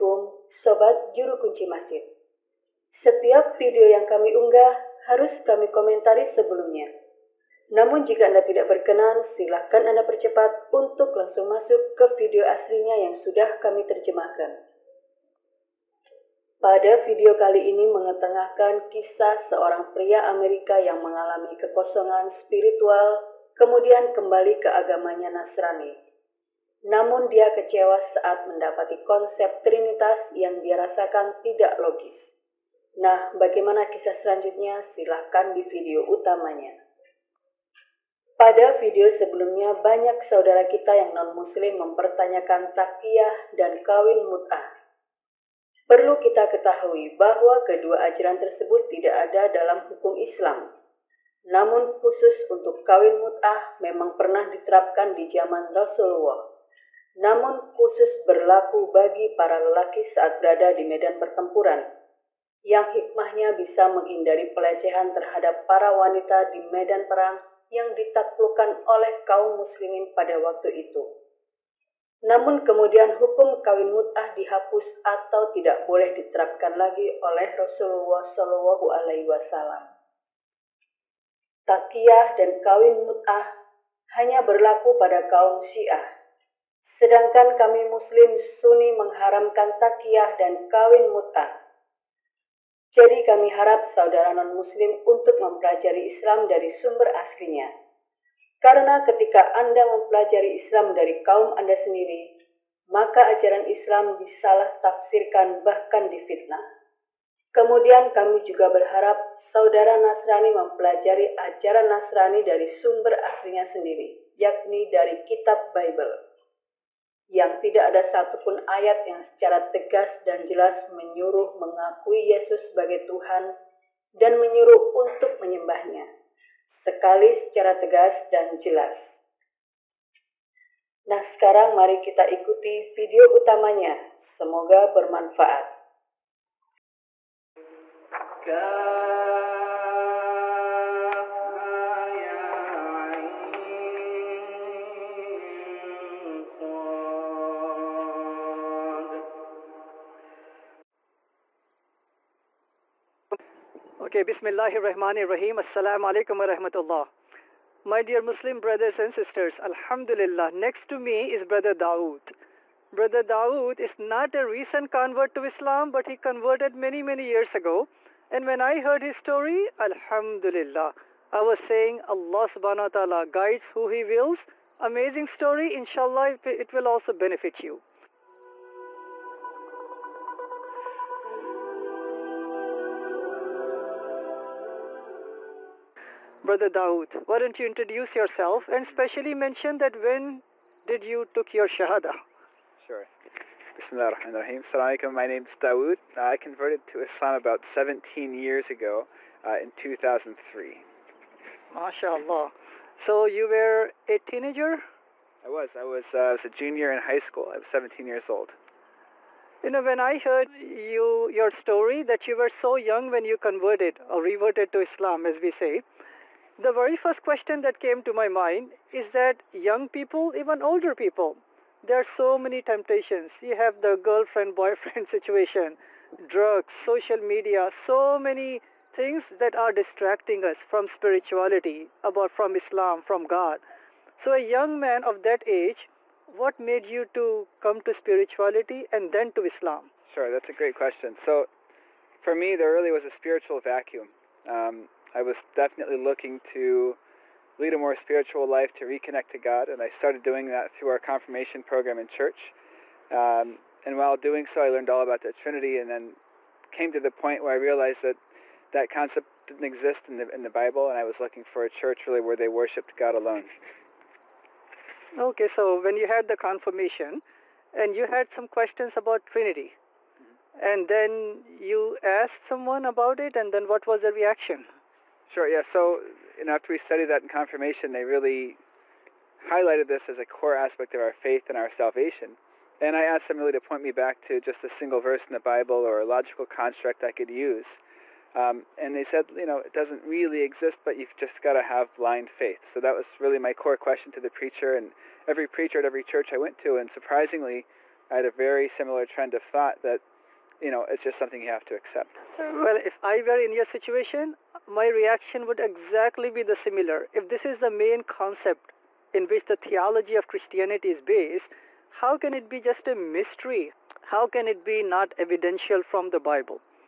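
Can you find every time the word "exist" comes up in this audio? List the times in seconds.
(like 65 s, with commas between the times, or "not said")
259 s, 290 s.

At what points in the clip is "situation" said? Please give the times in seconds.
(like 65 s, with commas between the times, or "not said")
225 s, 303 s.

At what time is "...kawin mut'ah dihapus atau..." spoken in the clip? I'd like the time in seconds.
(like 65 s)
73 s.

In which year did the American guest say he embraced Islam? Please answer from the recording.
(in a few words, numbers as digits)
2003.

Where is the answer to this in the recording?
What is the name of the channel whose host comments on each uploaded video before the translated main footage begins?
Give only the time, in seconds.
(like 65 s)
1 s.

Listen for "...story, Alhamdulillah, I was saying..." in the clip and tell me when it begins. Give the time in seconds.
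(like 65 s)
169 s.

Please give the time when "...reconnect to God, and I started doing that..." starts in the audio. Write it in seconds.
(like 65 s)
248 s.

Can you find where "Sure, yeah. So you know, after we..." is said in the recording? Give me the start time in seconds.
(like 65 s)
275 s.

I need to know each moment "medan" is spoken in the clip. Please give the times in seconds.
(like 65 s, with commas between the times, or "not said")
60 s, 66 s.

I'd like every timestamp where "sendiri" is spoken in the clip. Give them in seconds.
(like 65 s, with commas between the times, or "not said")
101 s, 113 s.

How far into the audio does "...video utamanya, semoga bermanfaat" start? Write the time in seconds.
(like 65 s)
132 s.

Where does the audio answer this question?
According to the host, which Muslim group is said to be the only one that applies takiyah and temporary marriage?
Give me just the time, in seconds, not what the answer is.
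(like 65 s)
85 s.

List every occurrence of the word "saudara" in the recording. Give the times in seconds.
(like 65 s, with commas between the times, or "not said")
40 s, 93 s, 109 s.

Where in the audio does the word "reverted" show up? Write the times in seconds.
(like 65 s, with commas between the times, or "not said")
214 s.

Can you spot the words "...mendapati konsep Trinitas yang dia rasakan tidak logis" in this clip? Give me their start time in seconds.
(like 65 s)
28 s.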